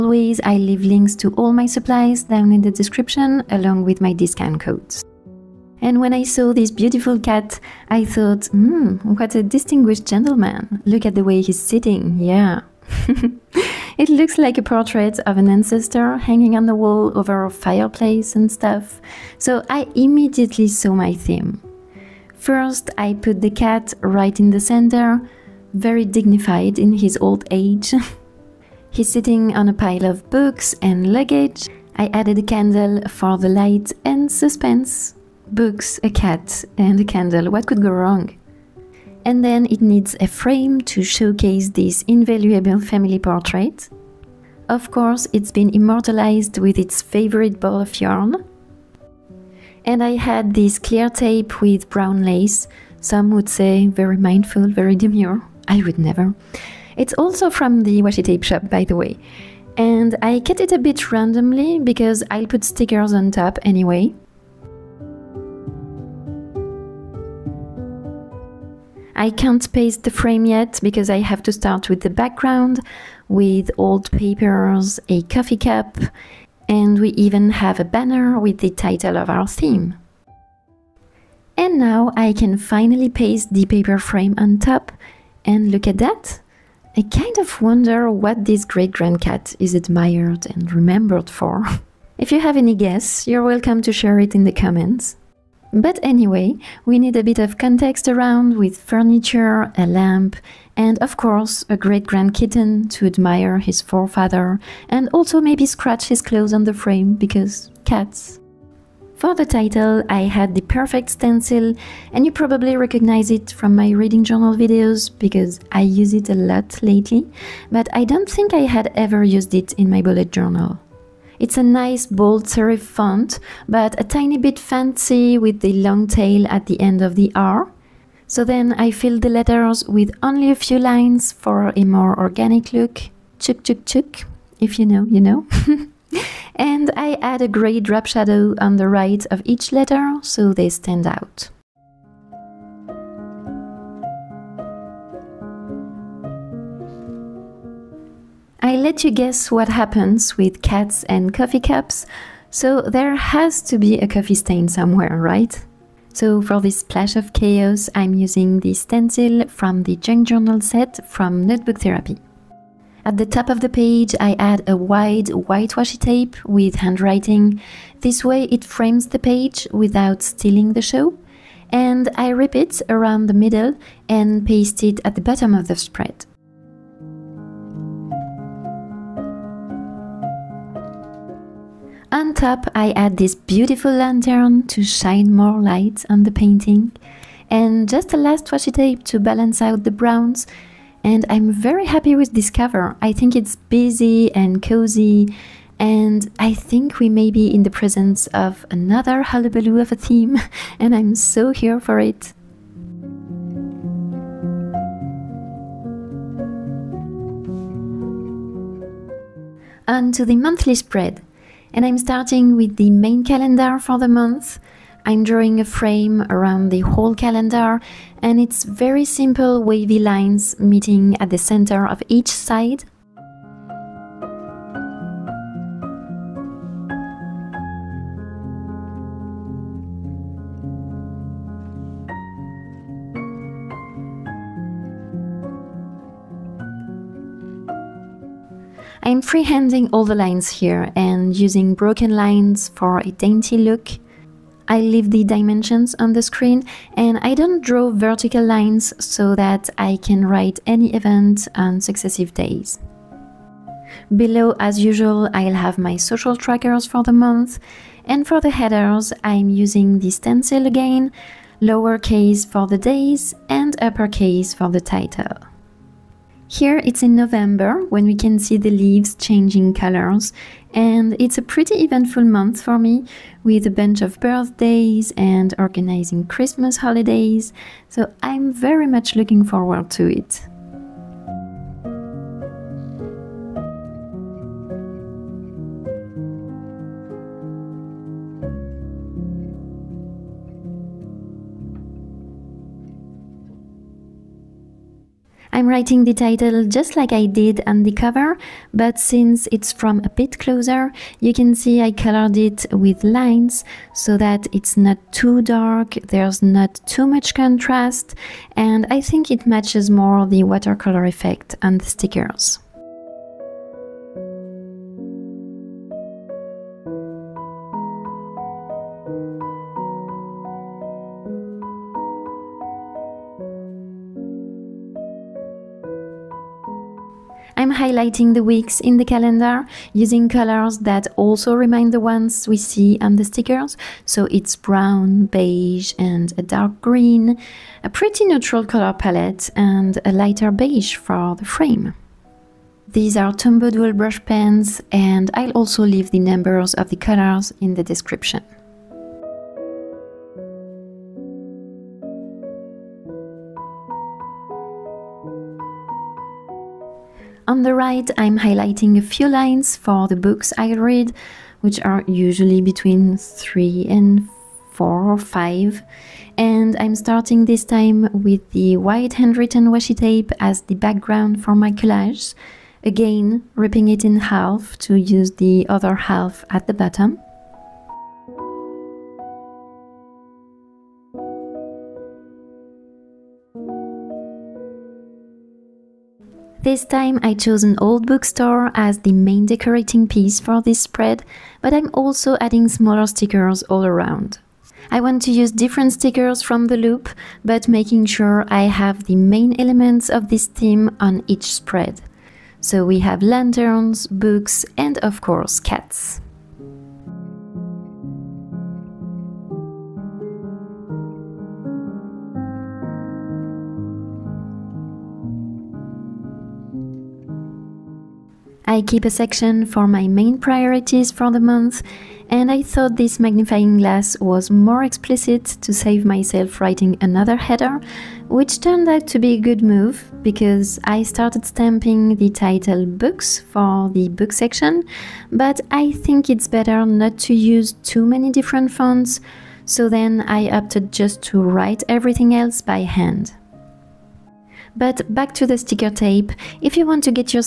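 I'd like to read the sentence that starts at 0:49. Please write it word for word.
And I had this clear tape with brown lace.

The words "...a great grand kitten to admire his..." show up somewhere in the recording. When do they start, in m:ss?
1:41.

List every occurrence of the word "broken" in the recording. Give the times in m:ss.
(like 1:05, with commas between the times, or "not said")
4:01.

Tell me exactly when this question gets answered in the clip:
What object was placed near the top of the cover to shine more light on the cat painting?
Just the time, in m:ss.
3:03.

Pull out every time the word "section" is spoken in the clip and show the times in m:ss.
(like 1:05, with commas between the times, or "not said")
6:59, 7:14.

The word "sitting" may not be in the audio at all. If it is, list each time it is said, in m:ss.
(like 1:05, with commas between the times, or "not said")
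0:11, 0:29.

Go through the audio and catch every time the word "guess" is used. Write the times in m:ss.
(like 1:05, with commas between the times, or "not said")
1:32, 2:29.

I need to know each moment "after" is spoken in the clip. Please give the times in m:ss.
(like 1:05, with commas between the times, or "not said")
not said.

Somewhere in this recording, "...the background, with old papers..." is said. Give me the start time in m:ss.
1:12.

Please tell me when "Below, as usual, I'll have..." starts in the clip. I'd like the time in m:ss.
4:14.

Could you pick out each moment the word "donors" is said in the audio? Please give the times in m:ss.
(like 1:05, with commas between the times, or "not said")
not said.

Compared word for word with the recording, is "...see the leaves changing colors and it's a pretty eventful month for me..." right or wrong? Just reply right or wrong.
right.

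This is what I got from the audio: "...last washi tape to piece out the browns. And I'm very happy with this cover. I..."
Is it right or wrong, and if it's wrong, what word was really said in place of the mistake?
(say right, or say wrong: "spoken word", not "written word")
wrong: "balance", not "piece".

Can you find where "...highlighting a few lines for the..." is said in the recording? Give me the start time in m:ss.
5:58.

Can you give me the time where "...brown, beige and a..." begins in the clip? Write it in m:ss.
5:34.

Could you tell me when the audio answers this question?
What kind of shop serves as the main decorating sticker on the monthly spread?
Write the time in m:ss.
6:27.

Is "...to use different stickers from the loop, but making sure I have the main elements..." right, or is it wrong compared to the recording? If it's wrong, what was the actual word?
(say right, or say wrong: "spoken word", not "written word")
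right.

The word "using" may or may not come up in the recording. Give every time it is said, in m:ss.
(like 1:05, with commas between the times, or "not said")
2:38, 4:01, 4:19, 5:29.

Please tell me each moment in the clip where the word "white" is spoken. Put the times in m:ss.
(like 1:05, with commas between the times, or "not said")
2:45, 6:08.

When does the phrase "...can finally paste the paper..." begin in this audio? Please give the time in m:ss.
1:22.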